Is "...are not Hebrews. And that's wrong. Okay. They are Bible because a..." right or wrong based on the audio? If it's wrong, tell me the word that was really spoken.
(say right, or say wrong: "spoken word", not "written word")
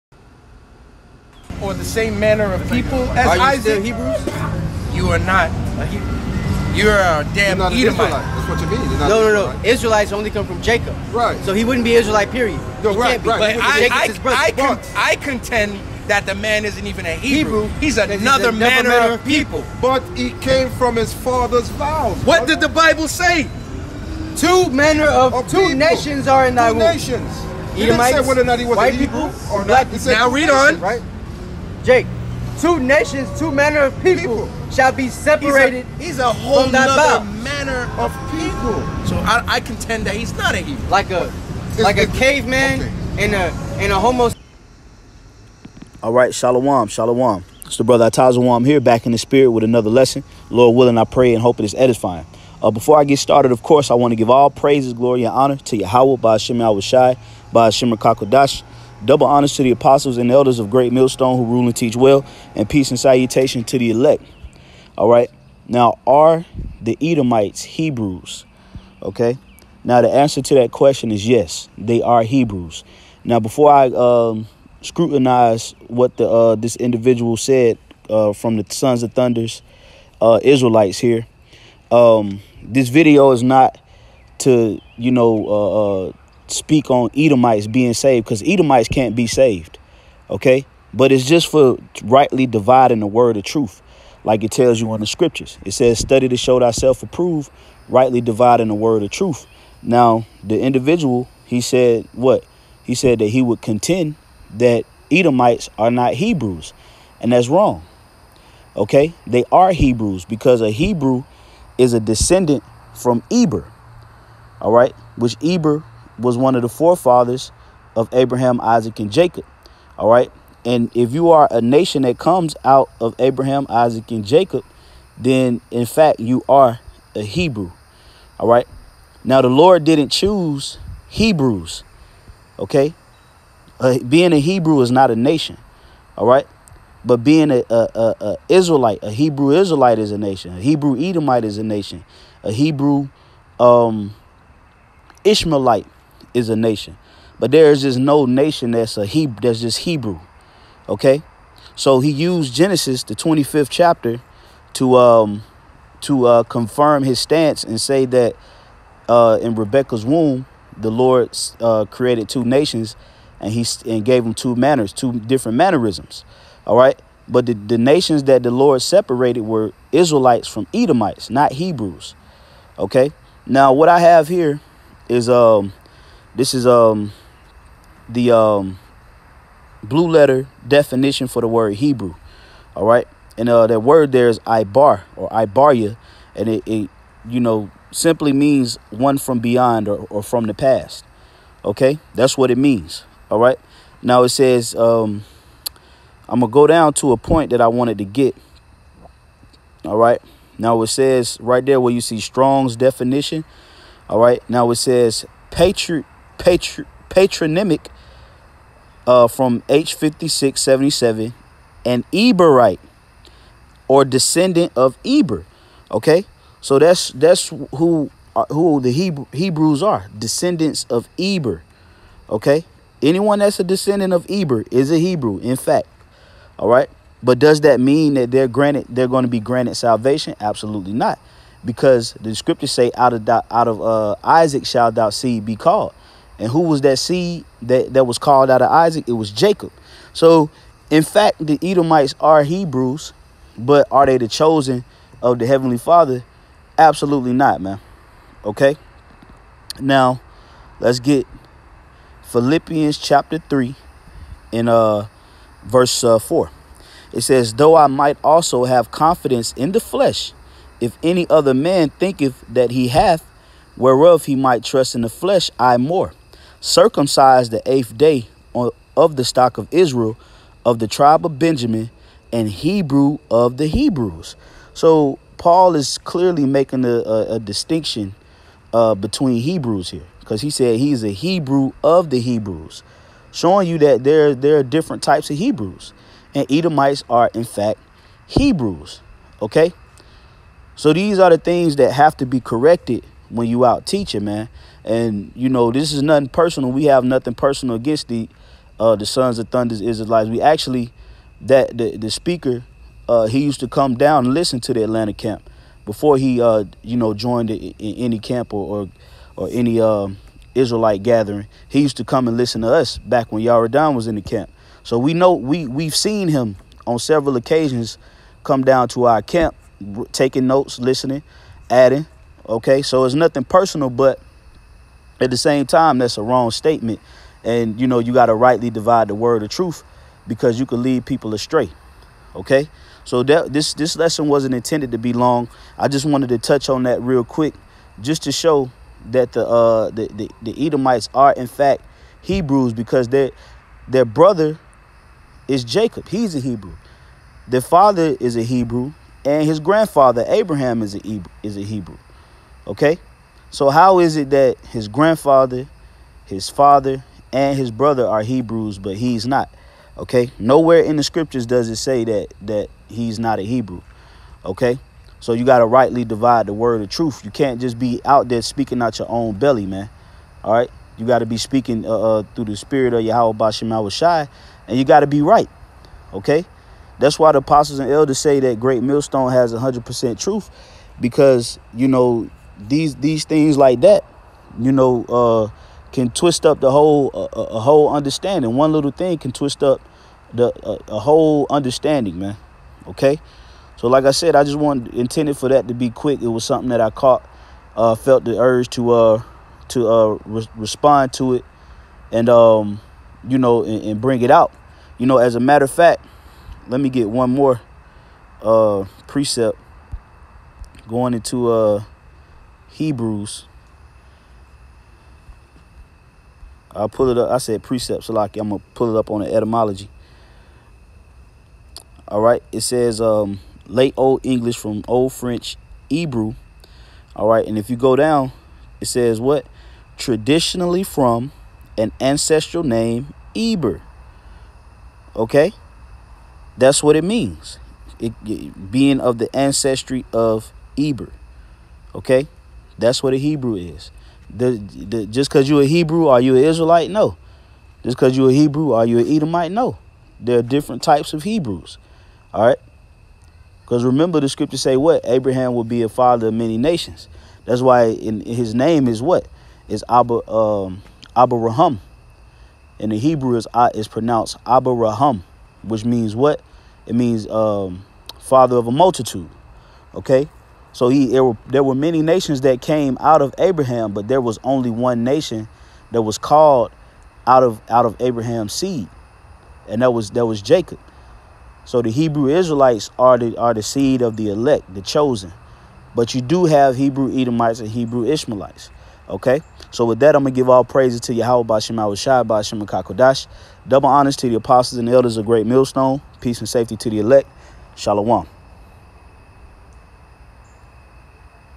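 wrong: "Hebrews", not "Bible".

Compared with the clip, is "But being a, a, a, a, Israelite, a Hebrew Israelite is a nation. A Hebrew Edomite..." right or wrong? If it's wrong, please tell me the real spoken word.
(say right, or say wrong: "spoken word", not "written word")
right.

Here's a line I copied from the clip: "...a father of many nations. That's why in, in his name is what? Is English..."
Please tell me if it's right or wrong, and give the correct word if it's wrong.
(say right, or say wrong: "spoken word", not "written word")
wrong: "Abba", not "English".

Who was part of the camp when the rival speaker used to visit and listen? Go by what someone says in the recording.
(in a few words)
Yaradan.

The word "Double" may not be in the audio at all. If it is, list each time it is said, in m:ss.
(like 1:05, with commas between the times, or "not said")
0:59, 8:13.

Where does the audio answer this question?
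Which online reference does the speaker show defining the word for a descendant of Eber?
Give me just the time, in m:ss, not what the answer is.
2:59.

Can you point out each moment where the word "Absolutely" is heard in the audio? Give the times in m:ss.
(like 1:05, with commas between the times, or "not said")
3:50, 4:06.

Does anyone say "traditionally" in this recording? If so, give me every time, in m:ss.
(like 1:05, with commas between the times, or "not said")
7:09.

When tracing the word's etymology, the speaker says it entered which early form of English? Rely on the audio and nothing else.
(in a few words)
Late Old English.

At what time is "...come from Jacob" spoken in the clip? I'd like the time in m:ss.
0:10.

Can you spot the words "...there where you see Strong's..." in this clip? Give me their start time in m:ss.
3:21.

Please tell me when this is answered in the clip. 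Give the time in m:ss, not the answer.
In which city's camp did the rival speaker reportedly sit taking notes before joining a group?
5:04.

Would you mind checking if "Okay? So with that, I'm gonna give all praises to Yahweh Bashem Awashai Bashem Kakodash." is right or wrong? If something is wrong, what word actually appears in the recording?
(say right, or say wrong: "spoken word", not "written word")
right.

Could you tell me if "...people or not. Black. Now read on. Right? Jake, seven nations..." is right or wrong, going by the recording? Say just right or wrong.
wrong.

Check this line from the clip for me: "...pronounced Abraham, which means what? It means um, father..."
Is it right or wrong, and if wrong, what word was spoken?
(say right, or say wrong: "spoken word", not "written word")
right.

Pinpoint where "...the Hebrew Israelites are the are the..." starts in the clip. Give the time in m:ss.
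8:01.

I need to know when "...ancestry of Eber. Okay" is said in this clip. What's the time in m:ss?
7:19.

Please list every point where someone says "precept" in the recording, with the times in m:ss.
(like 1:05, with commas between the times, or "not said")
6:49, 6:57.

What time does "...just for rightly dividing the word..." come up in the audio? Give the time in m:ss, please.
1:31.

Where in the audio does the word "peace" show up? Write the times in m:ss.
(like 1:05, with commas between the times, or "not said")
1:02, 8:16.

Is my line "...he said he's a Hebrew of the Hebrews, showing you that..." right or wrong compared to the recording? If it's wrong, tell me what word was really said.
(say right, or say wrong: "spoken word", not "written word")
right.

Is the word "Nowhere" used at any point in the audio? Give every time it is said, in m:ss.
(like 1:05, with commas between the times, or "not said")
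6:00.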